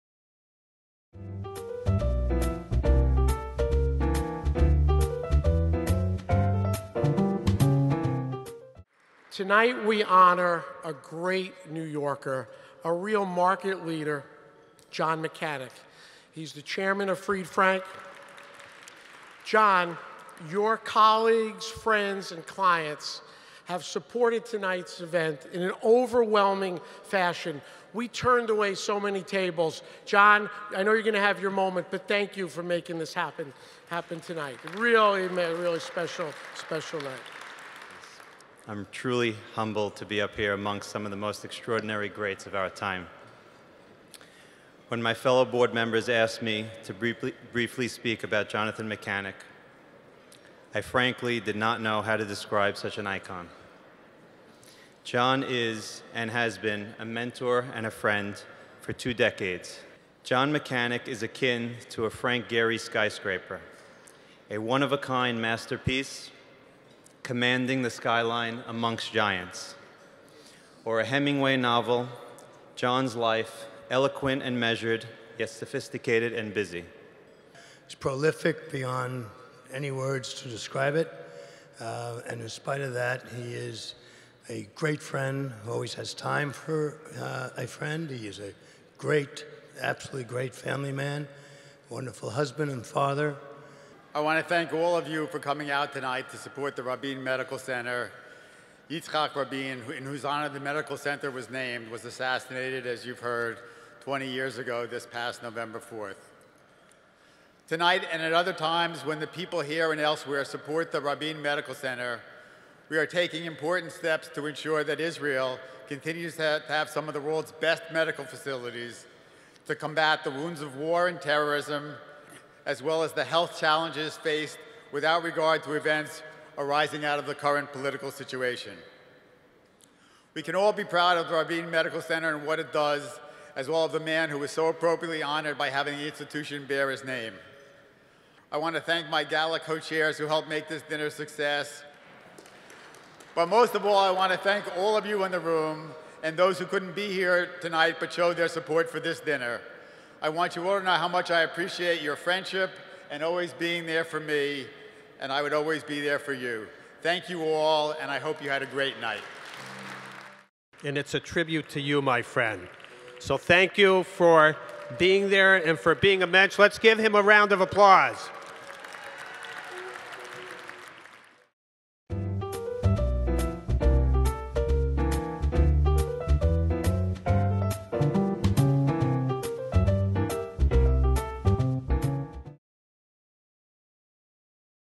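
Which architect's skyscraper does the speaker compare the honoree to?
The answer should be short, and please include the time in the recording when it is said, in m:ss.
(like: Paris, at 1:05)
Frank Gehry, at 1:02.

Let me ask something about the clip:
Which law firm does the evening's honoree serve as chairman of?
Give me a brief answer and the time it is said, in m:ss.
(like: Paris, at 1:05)
Fried Frank, at 0:17.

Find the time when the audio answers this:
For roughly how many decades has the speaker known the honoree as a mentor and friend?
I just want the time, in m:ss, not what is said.
0:58.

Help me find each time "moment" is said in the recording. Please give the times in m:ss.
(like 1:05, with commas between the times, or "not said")
0:31.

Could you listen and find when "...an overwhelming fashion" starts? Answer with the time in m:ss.
0:25.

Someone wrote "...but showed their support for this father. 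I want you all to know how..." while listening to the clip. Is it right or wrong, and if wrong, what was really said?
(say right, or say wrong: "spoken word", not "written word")
wrong: "dinner", not "father".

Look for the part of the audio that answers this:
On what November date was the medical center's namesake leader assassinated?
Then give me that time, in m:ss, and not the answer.
1:45.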